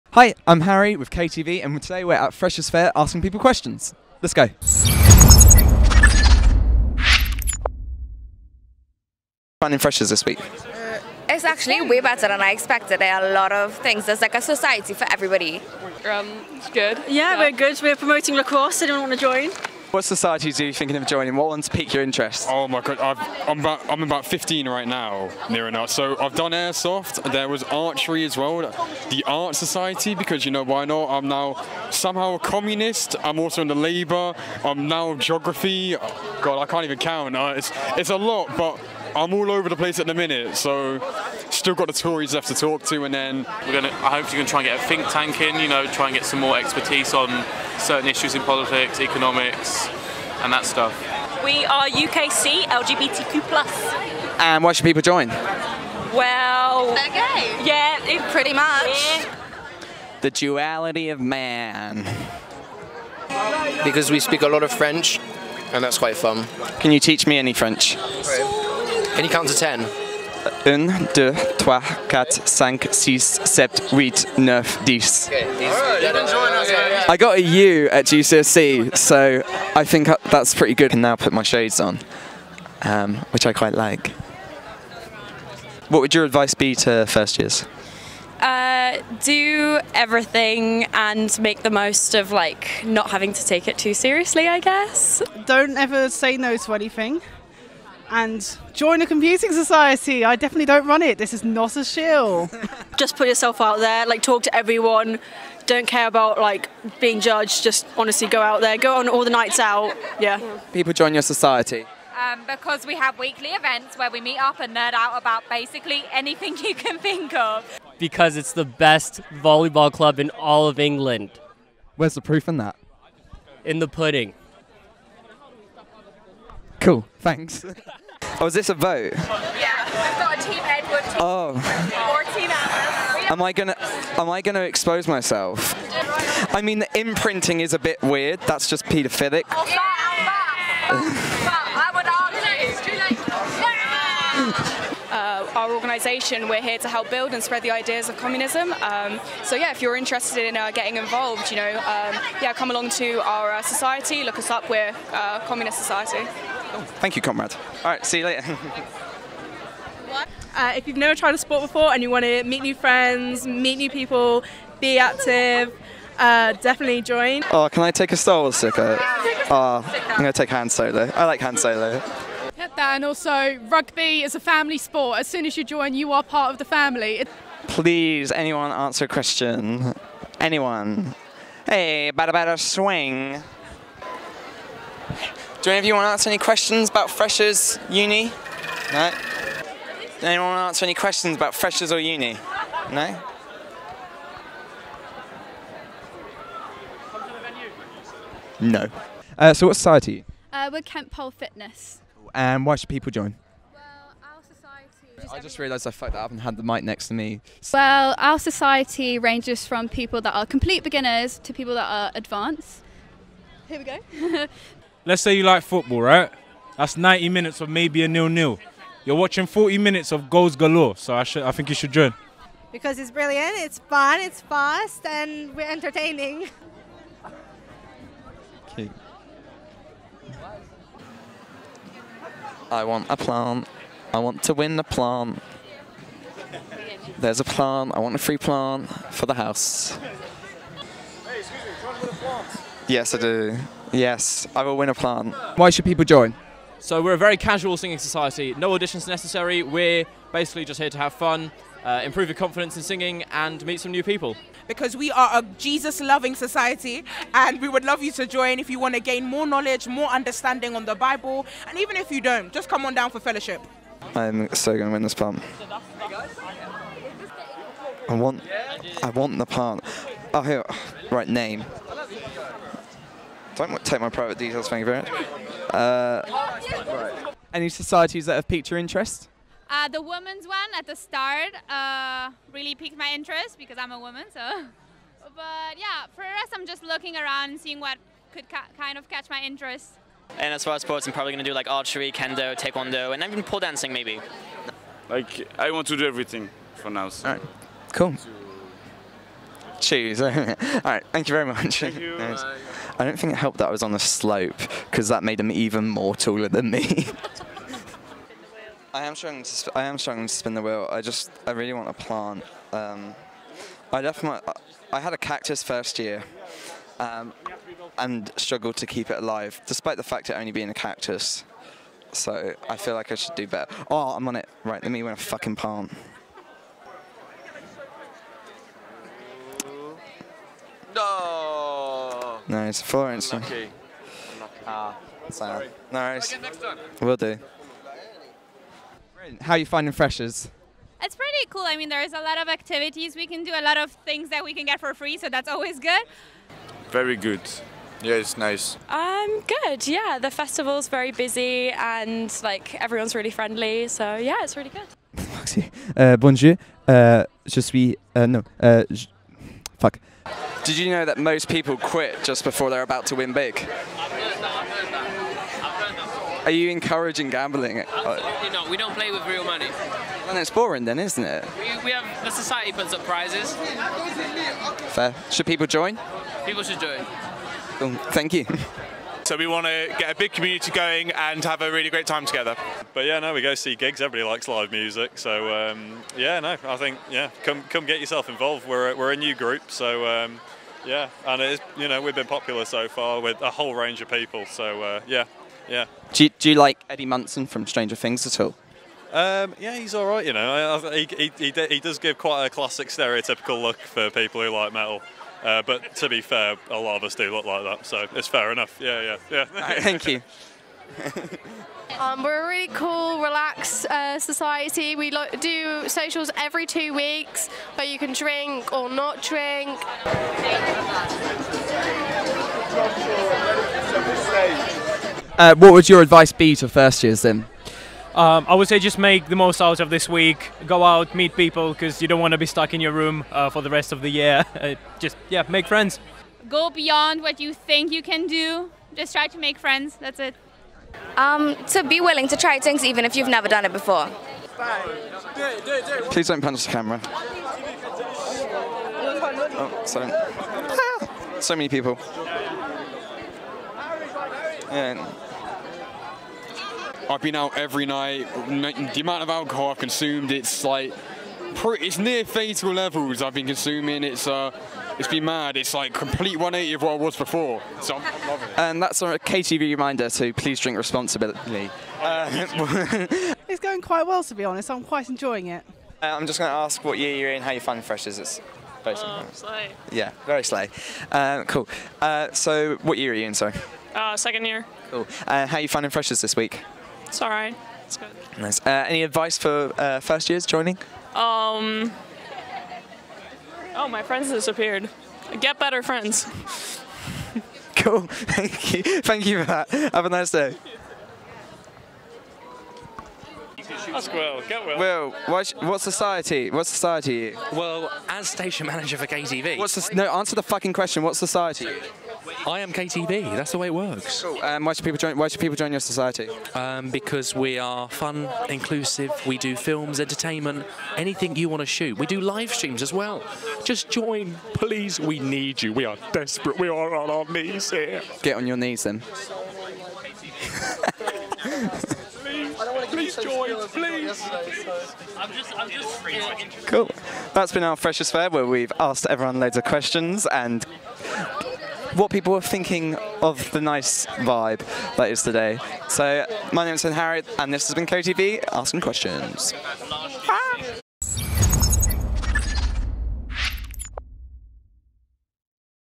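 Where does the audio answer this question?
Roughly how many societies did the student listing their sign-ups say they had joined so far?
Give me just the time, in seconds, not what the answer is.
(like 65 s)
24 s.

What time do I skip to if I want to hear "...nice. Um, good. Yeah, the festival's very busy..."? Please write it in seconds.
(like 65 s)
348 s.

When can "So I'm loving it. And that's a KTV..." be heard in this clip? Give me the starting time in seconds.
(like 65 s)
467 s.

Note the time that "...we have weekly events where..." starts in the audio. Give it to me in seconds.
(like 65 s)
112 s.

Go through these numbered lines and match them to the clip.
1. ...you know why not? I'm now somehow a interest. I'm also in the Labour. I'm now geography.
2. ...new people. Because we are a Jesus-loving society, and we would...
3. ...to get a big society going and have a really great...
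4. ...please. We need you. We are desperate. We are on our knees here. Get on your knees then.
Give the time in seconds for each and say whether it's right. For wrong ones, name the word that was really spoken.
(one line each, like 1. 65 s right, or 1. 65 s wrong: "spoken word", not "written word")
1. 30 s wrong: "communist", not "interest"
2. 253 s right
3. 379 s wrong: "community", not "society"
4. 524 s right.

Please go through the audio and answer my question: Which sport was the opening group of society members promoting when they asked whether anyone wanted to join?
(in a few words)
Lacrosse.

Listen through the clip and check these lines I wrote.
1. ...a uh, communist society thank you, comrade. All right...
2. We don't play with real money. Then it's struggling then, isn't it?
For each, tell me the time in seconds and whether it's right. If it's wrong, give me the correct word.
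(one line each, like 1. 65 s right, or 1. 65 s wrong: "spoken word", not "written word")
1. 154 s right
2. 368 s wrong: "boring", not "struggling".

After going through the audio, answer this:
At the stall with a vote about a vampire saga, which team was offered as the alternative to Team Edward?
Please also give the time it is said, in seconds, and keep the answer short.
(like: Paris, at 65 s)
Team Alice, at 132 s.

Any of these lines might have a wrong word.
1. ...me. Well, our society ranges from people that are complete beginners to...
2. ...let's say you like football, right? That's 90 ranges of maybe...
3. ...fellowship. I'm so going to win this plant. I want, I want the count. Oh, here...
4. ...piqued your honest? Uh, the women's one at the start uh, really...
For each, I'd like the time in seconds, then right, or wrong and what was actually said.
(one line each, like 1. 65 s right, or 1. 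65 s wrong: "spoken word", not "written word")
1. 207 s right
2. 215 s wrong: "minutes", not "ranges"
3. 263 s wrong: "plant", not "count"
4. 278 s wrong: "interest", not "honest".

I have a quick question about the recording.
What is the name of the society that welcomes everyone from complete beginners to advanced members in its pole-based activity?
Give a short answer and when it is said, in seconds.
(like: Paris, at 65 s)
Kent Pole Fitness, at 200 s.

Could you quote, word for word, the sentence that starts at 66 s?
Can you teach me any French?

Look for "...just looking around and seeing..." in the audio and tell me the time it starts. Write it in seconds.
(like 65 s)
286 s.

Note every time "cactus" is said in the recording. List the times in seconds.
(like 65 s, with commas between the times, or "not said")
315 s, 320 s.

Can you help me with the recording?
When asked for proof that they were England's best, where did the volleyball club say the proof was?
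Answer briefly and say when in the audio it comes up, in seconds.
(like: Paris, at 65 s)
In the pudding, at 123 s.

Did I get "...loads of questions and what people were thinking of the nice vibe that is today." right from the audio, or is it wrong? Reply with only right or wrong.
right.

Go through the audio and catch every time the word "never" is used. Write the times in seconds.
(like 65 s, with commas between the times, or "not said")
160 s, 443 s.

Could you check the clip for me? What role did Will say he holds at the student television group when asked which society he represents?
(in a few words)
Station manager.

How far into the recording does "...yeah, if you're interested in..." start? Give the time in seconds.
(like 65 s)
149 s.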